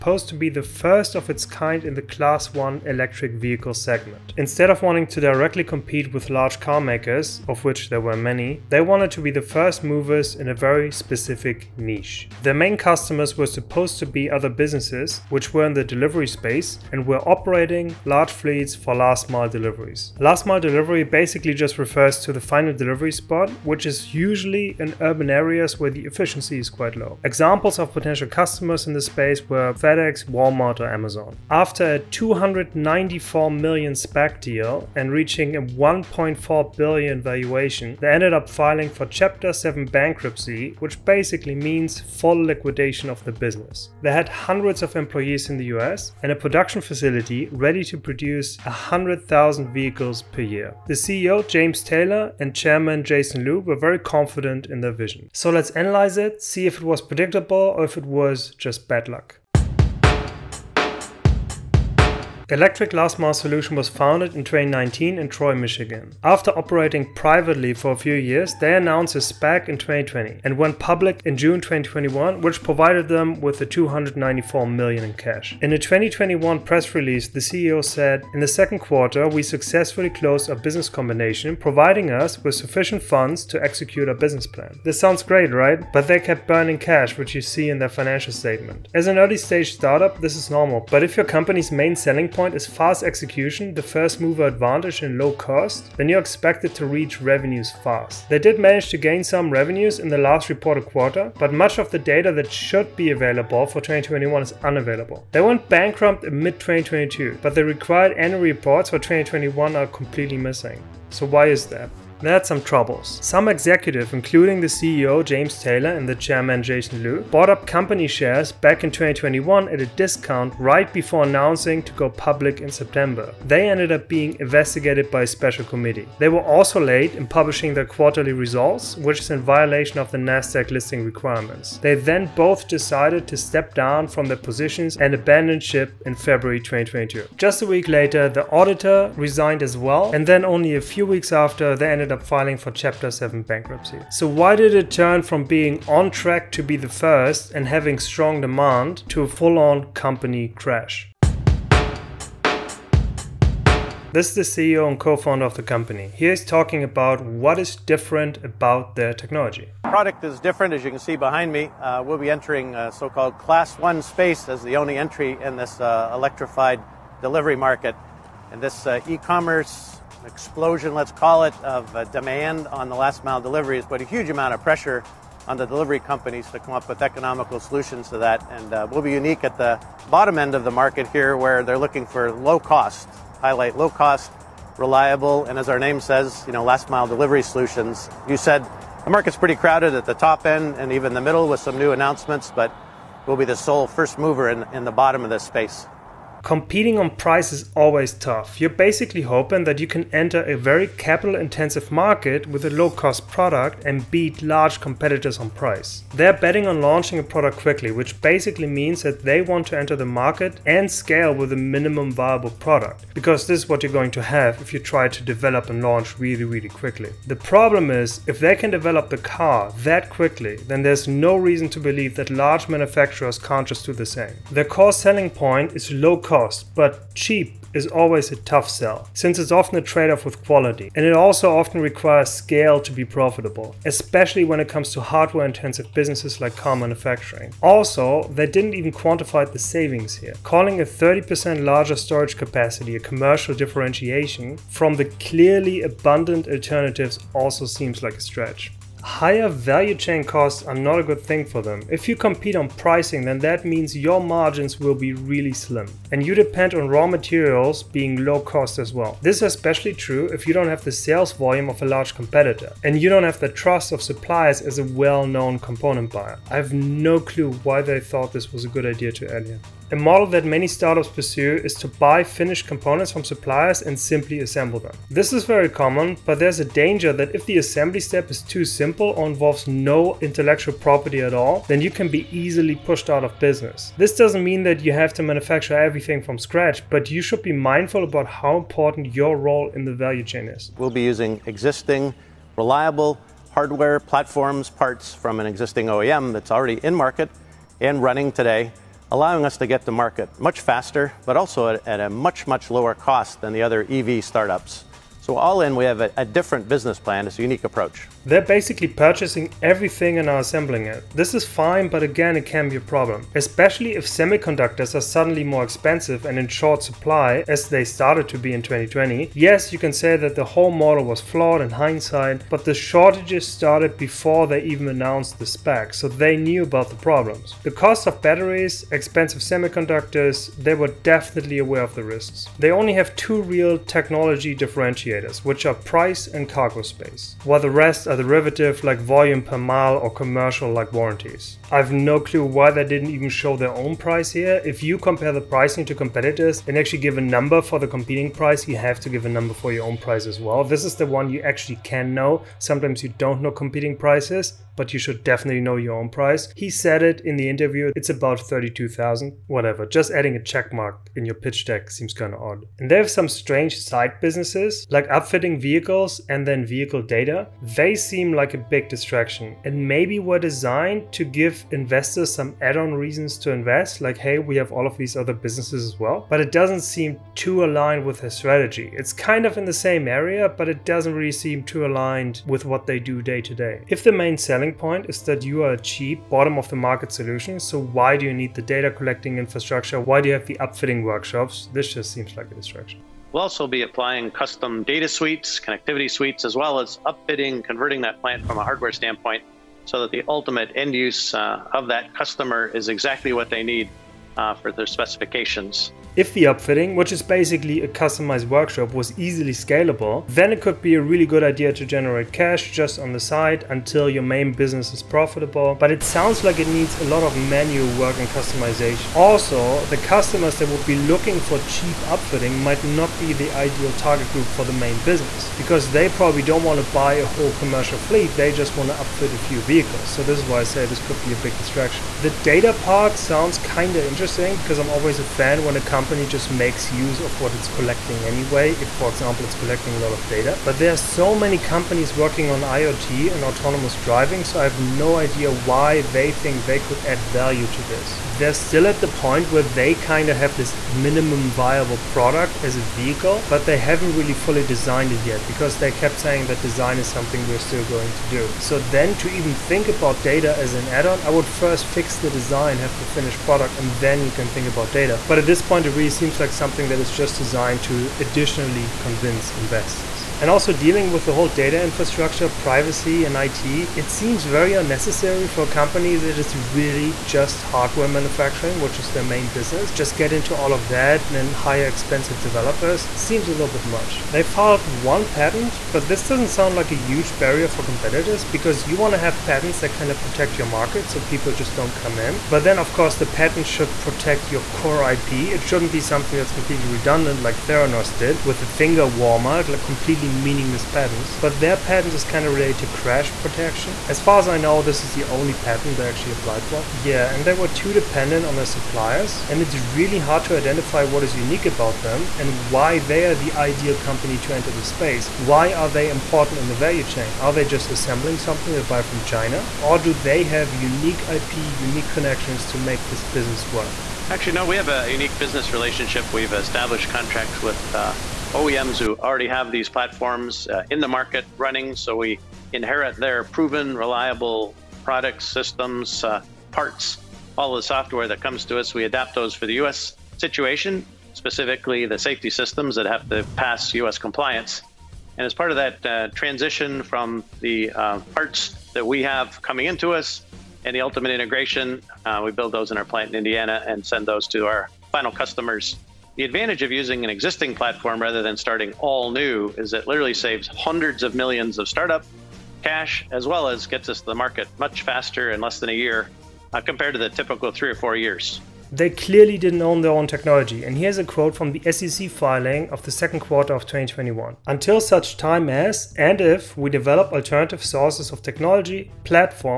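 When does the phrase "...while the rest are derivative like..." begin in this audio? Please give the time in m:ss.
5:37.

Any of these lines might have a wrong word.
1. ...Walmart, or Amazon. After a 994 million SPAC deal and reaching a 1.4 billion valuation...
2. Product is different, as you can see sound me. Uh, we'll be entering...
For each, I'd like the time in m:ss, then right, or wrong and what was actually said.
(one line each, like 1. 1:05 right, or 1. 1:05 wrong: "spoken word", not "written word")
1. 0:30 wrong: "294", not "994"
2. 2:39 wrong: "behind", not "sound".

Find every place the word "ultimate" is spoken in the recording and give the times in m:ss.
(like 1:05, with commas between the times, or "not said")
6:40, 9:11.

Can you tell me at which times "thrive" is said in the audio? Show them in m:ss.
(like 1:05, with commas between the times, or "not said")
not said.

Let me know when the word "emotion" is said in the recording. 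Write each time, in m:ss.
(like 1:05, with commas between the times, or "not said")
not said.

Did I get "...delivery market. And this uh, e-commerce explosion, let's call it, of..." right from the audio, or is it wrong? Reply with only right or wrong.
right.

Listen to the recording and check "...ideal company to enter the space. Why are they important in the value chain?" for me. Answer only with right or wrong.
right.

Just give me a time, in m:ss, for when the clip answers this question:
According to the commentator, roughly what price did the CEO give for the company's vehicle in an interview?
5:58.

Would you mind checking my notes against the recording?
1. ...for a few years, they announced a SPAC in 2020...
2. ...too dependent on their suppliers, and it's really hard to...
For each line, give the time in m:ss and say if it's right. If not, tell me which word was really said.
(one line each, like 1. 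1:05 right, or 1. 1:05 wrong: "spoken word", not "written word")
1. 1:07 right
2. 8:27 right.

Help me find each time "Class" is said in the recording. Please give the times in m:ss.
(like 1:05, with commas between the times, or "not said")
0:02, 2:43.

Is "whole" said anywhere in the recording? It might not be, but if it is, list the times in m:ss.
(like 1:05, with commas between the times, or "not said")
5:20, 7:07, 7:51.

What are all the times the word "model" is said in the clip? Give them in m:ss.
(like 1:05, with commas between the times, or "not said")
4:29, 5:20.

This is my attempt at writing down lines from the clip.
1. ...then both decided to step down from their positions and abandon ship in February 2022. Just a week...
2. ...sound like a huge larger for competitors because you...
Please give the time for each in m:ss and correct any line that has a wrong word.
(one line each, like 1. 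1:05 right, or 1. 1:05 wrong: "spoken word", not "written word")
1. 2:11 right
2. 8:06 wrong: "barrier", not "larger".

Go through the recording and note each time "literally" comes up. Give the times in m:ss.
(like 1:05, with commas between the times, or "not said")
9:20.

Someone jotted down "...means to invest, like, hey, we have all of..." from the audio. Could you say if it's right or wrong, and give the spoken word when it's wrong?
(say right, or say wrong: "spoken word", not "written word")
wrong: "reasons", not "means".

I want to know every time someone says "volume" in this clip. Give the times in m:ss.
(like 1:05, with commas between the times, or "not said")
4:21, 5:38.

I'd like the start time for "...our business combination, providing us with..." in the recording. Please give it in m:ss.
1:20.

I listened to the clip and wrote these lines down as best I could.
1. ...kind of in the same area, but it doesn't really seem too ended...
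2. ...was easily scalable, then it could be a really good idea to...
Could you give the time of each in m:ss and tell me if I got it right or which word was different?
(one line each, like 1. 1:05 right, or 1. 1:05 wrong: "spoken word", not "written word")
1. 6:19 wrong: "aligned", not "ended"
2. 6:48 right.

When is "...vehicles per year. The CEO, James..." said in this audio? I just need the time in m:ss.
0:49.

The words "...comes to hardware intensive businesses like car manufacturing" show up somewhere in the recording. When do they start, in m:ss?
3:54.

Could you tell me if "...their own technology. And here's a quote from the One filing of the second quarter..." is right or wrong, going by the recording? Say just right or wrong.
wrong.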